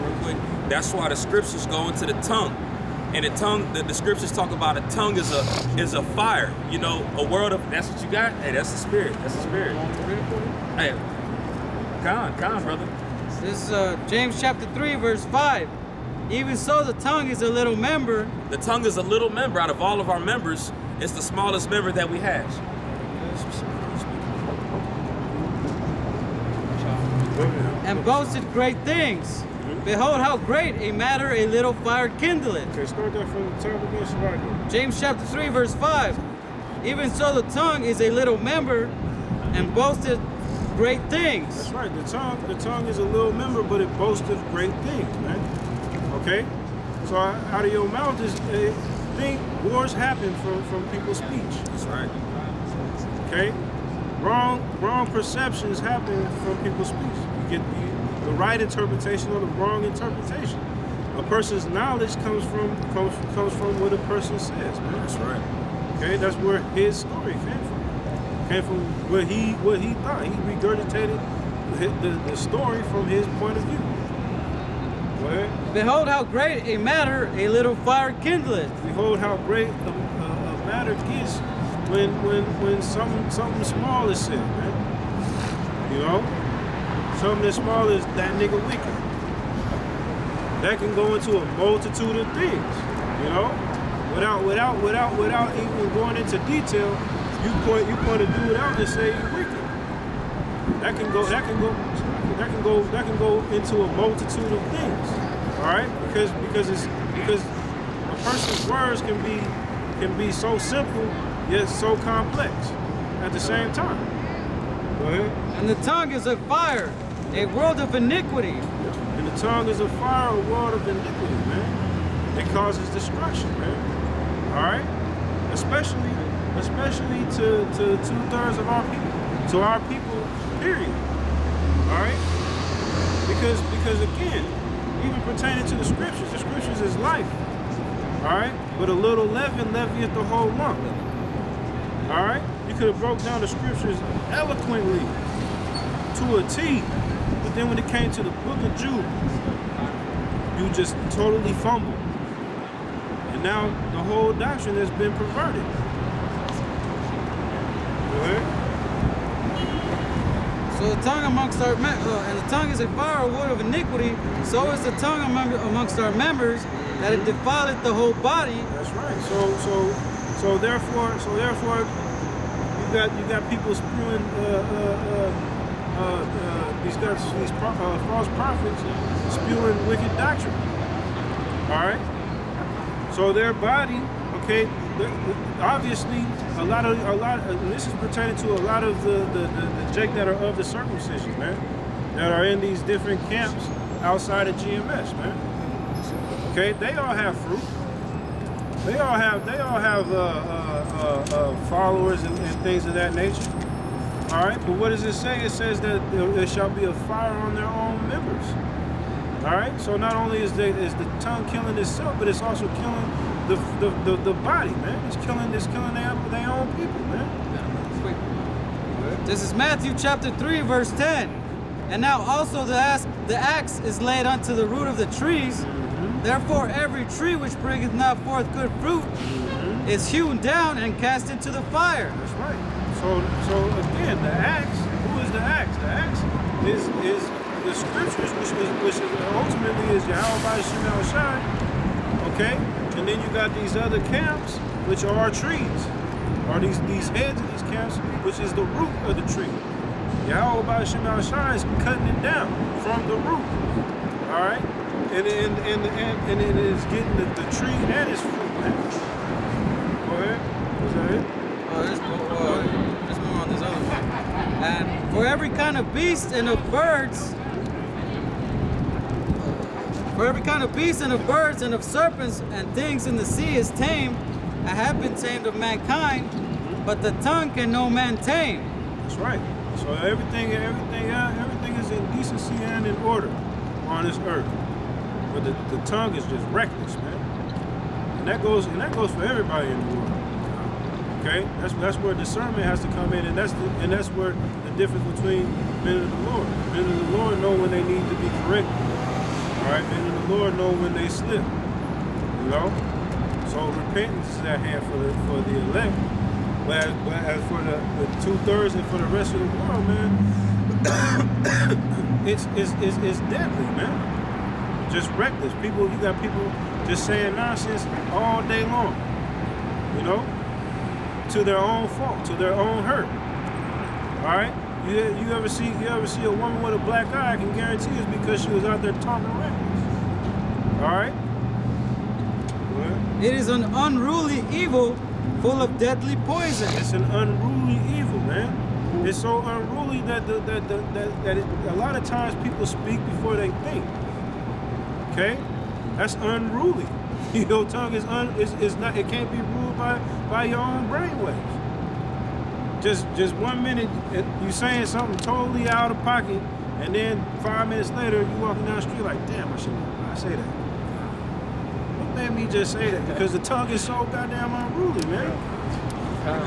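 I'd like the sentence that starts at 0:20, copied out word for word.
It's the smallest member that we have and boasted great things.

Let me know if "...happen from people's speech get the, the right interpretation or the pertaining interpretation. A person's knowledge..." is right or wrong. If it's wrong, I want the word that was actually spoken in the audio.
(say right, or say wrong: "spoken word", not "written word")
wrong: "wrong", not "pertaining".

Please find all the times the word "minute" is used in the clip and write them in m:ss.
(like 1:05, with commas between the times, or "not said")
5:53, 5:57.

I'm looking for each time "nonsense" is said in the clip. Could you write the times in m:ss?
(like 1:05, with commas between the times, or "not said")
5:17.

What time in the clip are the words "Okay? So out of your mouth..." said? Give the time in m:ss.
0:46.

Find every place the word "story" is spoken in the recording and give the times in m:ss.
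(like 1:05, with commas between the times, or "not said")
1:07, 1:12.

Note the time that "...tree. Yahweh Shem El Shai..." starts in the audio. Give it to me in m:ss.
4:09.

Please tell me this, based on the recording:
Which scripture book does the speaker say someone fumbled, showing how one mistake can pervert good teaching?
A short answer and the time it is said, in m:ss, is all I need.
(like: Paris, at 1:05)
Jude, at 2:28.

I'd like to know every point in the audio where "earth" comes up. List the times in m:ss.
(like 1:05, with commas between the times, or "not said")
4:44.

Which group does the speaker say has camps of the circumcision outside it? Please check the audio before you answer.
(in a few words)
GMS.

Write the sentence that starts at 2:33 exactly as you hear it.
And now the whole doctrine has been perverted.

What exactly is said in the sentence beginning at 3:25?
It says that there shall be a fire on their own members.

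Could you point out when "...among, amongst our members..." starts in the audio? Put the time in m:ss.
2:45.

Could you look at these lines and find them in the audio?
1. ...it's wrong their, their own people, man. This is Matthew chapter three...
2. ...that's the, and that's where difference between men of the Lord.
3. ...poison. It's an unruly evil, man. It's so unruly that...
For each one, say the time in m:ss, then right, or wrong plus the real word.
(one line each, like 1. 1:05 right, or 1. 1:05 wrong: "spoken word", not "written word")
1. 3:35 wrong: "killing", not "wrong"
2. 4:53 right
3. 5:36 right.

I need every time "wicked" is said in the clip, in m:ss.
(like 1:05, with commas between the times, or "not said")
1:39, 2:59.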